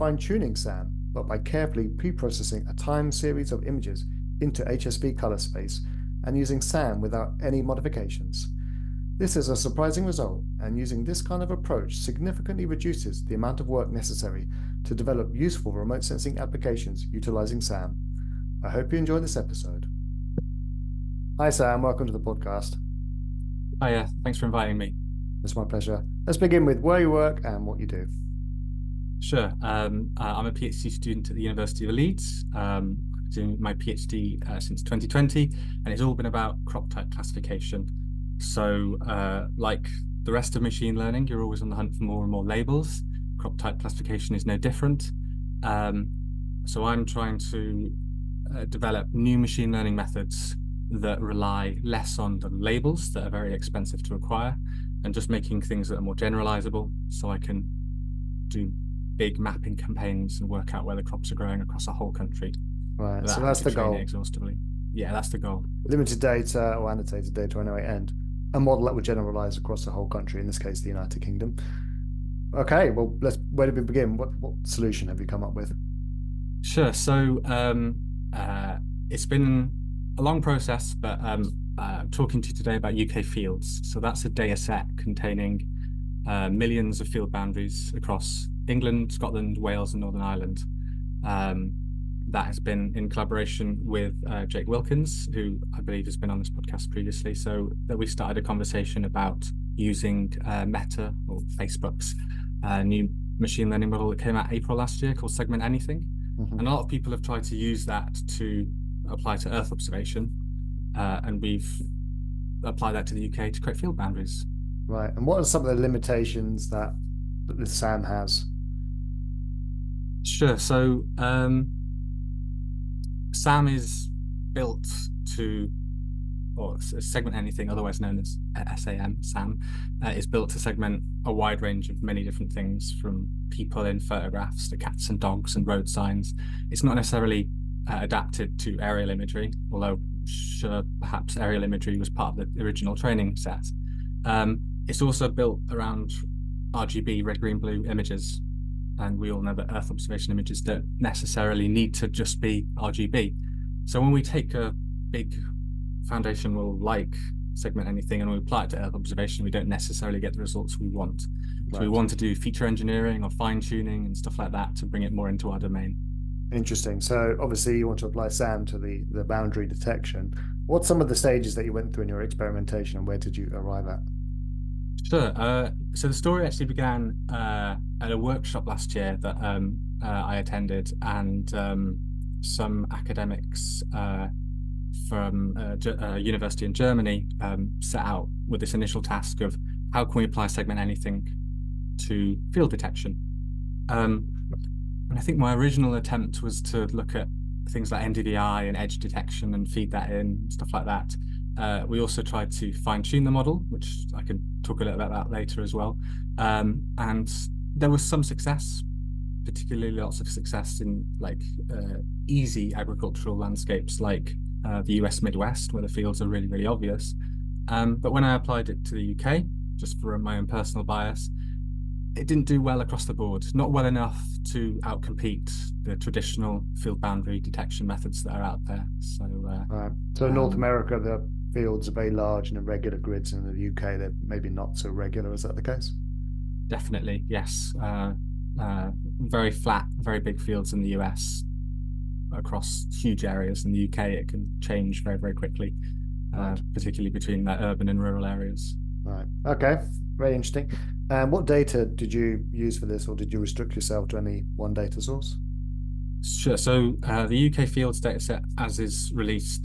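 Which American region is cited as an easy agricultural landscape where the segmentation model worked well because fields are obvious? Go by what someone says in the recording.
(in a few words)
US Midwest.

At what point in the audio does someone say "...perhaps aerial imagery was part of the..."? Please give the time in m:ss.
2:21.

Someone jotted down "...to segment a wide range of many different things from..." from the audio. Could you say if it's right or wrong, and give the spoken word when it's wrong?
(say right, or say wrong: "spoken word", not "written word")
right.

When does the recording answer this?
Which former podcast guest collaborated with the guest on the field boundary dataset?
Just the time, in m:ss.
1:34.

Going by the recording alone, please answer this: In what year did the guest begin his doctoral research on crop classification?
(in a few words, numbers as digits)
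2020.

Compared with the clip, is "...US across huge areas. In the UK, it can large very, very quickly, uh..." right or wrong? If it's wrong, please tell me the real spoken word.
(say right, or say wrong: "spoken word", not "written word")
wrong: "change", not "large".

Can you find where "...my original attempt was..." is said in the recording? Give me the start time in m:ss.
3:15.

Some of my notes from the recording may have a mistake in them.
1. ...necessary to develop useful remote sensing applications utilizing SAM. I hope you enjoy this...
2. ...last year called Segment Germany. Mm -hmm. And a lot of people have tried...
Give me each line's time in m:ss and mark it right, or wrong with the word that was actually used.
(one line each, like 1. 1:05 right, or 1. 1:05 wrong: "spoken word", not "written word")
1. 0:13 right
2. 1:44 wrong: "Anything", not "Germany".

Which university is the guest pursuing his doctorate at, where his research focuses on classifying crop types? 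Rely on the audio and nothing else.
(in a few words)
University of Leeds.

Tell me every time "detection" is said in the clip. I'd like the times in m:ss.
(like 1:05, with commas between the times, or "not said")
2:49, 3:12, 3:18, 3:47.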